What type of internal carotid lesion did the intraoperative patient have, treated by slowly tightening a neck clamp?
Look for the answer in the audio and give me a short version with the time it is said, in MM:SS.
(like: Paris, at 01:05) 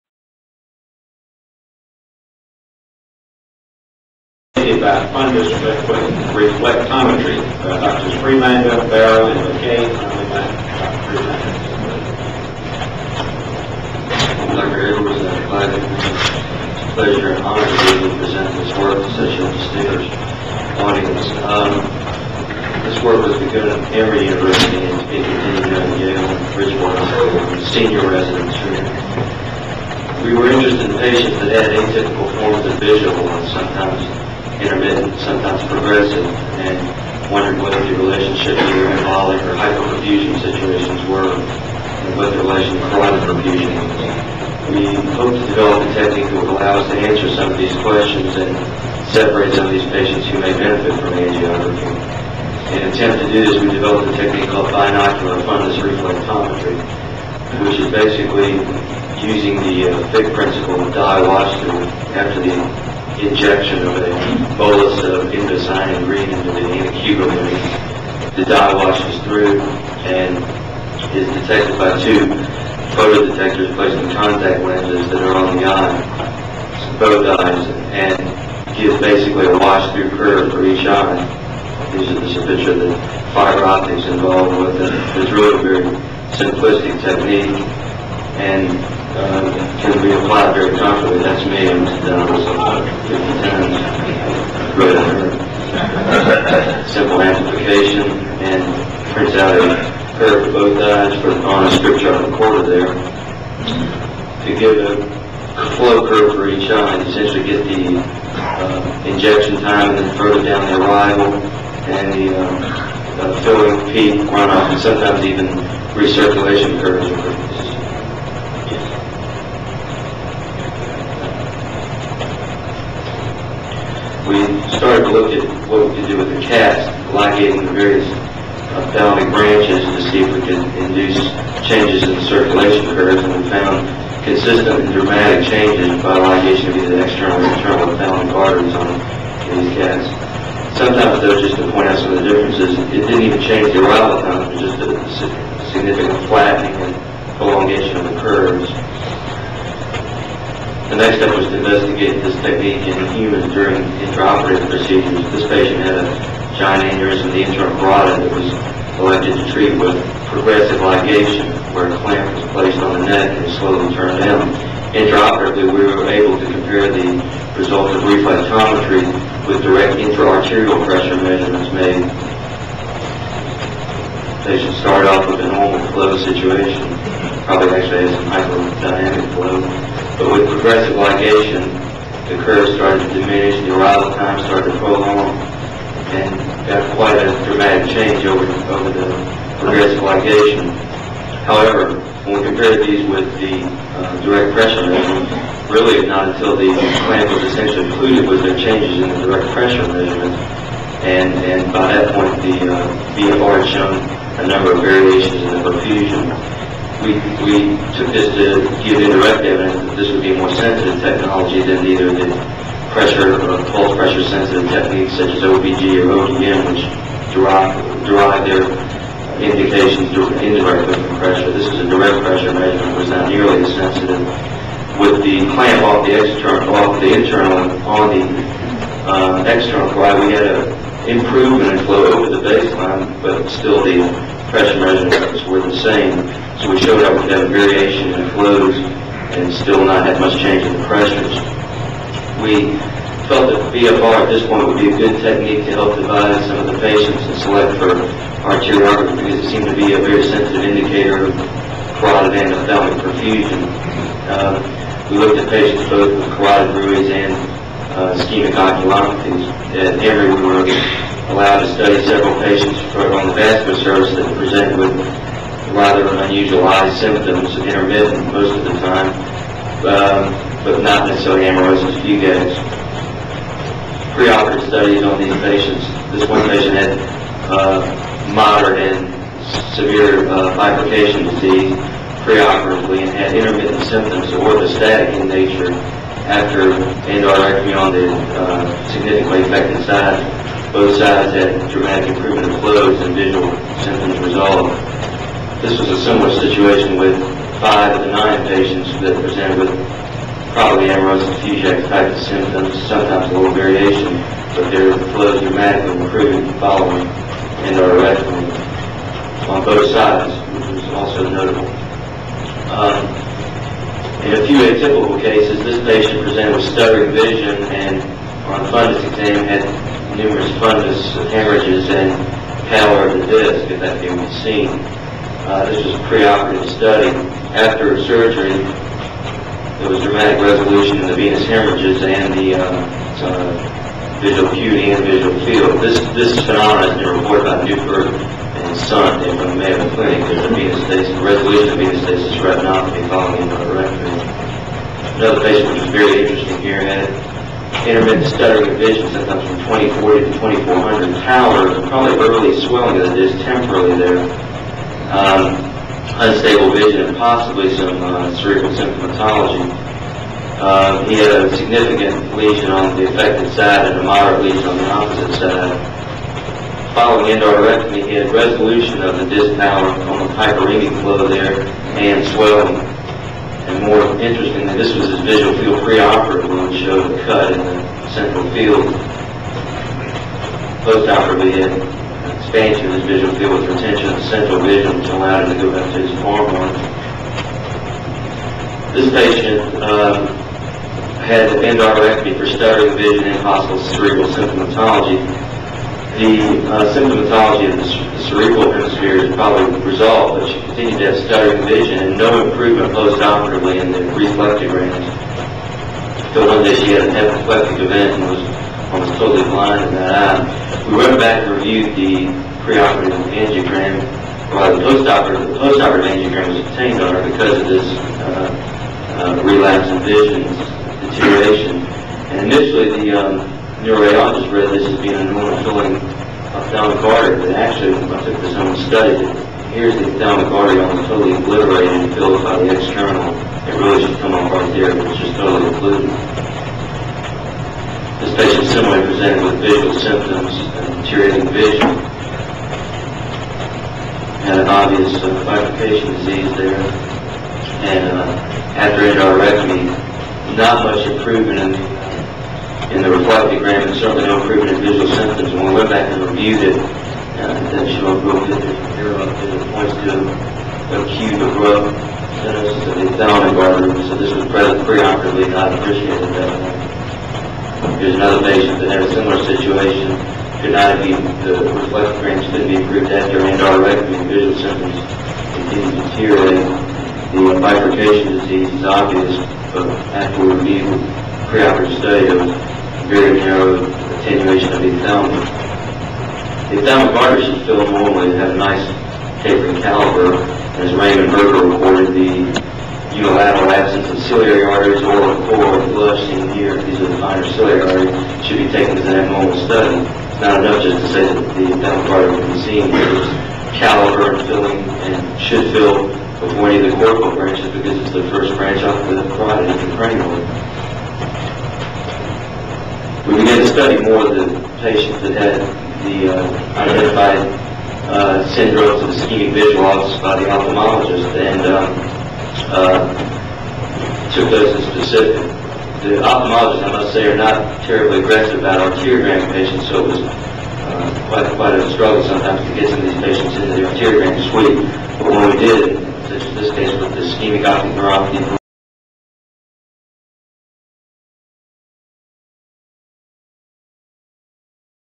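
giant aneurysm, at 02:36.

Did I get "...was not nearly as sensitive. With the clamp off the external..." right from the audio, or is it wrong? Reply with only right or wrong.
right.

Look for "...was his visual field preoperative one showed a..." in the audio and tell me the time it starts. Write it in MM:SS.
06:14.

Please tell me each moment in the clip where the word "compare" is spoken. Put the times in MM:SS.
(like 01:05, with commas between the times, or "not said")
02:46, 03:12.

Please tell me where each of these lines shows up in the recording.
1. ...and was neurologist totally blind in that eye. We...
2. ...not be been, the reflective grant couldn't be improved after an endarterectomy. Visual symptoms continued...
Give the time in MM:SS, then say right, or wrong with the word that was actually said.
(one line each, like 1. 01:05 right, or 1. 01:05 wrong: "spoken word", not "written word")
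1. 06:48 wrong: "almost", not "neurologist"
2. 07:50 right.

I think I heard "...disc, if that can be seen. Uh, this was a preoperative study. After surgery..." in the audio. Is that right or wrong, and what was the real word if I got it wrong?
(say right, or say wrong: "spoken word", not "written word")
right.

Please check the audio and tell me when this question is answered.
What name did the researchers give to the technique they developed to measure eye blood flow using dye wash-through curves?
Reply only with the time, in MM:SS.
00:54.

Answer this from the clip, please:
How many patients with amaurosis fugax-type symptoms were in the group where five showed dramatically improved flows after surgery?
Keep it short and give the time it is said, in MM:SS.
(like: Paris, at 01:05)
9, at 04:58.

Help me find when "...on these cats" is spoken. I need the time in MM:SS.
02:18.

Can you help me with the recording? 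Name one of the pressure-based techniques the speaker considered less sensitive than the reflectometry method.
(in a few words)
OPG.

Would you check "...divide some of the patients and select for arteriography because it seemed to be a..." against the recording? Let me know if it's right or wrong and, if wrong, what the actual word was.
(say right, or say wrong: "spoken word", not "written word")
right.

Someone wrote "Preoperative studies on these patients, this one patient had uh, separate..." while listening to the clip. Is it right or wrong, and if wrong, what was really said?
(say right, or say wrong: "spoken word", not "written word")
wrong: "moderate", not "separate".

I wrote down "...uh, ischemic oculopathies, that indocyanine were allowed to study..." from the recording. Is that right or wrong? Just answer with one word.
wrong.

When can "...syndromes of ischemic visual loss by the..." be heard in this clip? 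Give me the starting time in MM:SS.
08:38.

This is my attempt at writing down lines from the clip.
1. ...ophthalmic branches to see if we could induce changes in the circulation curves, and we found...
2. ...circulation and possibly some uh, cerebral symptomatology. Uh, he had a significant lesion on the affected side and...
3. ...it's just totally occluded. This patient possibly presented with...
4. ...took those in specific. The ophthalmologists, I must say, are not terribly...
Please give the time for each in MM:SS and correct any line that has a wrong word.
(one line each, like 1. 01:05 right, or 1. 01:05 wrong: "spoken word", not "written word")
1. 02:08 right
2. 05:56 wrong: "vision", not "circulation"
3. 07:15 wrong: "similarly", not "possibly"
4. 08:44 right.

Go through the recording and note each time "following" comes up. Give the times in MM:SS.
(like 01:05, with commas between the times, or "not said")
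05:06, 05:43, 06:06.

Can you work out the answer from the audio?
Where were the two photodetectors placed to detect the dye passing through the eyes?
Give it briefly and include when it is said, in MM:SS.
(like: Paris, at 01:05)
contact lenses, at 01:14.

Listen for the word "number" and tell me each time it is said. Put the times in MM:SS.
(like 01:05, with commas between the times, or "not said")
03:24.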